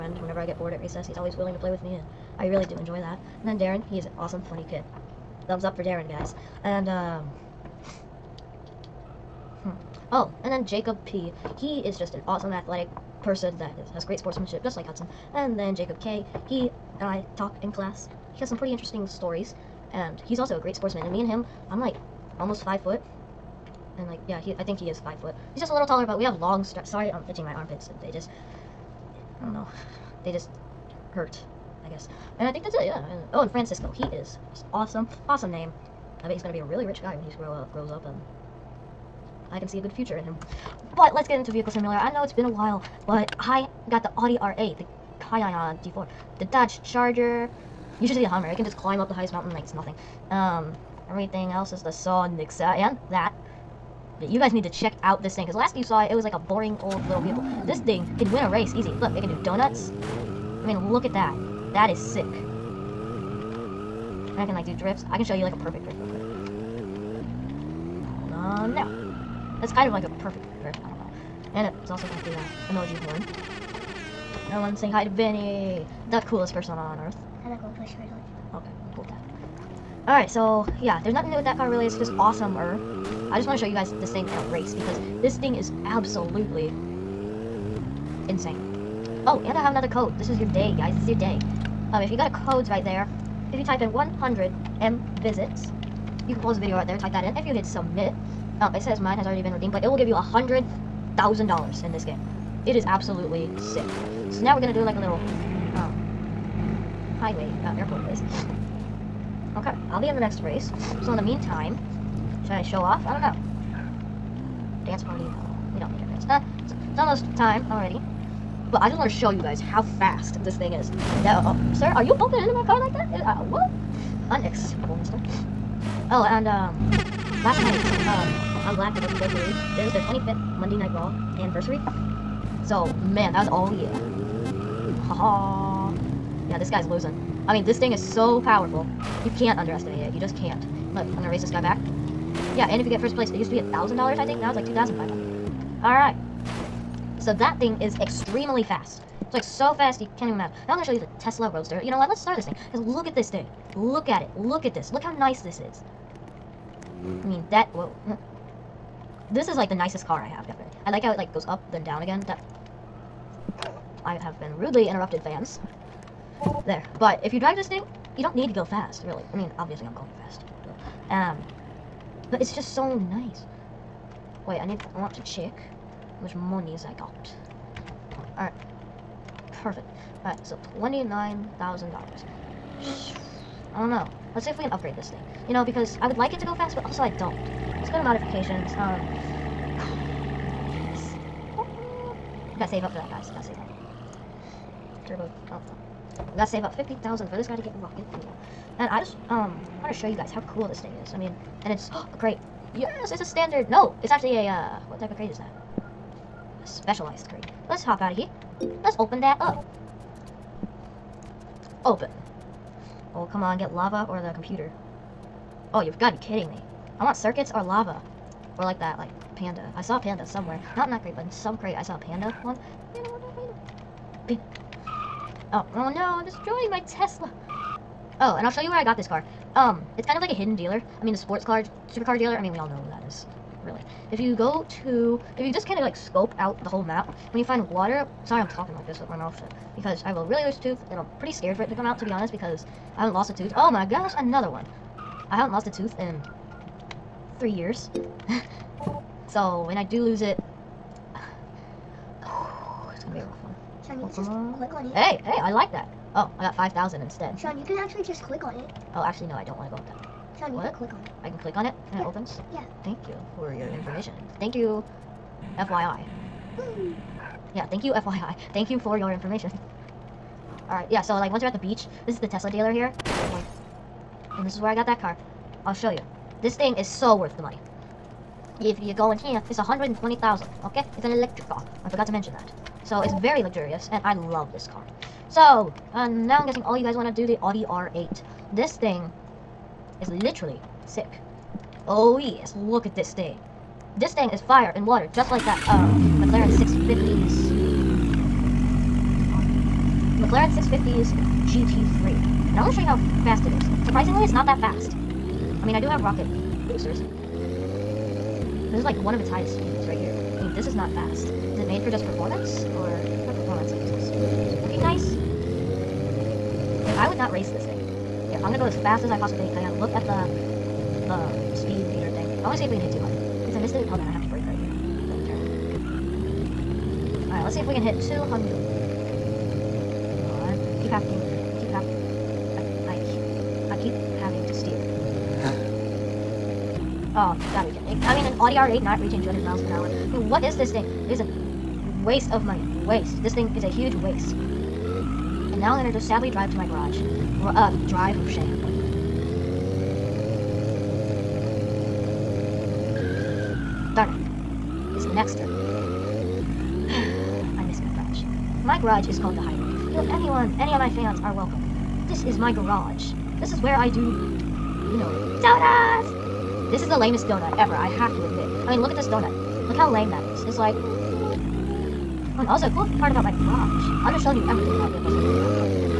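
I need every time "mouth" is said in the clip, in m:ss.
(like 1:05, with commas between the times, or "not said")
3:59.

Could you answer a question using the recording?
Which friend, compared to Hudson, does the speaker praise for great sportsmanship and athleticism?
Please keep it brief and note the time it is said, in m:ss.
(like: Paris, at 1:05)
Jacob P., at 0:10.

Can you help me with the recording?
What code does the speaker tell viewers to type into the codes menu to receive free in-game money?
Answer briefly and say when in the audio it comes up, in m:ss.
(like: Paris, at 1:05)
100 M visits, at 1:33.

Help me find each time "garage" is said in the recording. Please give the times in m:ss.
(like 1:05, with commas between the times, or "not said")
5:46, 6:02, 6:13.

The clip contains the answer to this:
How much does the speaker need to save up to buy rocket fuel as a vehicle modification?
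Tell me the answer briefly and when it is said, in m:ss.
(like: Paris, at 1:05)
50,000, at 3:16.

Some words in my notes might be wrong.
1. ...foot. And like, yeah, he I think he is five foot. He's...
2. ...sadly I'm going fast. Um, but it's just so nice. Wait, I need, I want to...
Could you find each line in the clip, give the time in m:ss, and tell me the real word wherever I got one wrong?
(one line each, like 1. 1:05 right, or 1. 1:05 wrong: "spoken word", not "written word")
1. 0:22 right
2. 2:49 wrong: "obviously", not "sadly".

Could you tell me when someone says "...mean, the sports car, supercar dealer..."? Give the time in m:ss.
3:51.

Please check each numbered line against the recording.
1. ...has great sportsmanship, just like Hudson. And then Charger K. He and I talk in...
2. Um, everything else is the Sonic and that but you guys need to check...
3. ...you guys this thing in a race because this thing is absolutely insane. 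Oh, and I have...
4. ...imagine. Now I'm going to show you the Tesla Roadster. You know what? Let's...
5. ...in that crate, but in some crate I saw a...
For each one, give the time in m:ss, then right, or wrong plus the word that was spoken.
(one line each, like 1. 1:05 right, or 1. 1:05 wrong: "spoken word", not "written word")
1. 0:13 wrong: "Jacob", not "Charger"
2. 0:50 right
3. 1:23 right
4. 2:30 right
5. 3:40 right.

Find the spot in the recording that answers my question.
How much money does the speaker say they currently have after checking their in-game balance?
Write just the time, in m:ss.
3:00.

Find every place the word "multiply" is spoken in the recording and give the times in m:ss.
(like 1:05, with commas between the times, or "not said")
not said.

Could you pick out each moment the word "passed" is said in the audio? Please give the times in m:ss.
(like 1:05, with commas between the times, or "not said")
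not said.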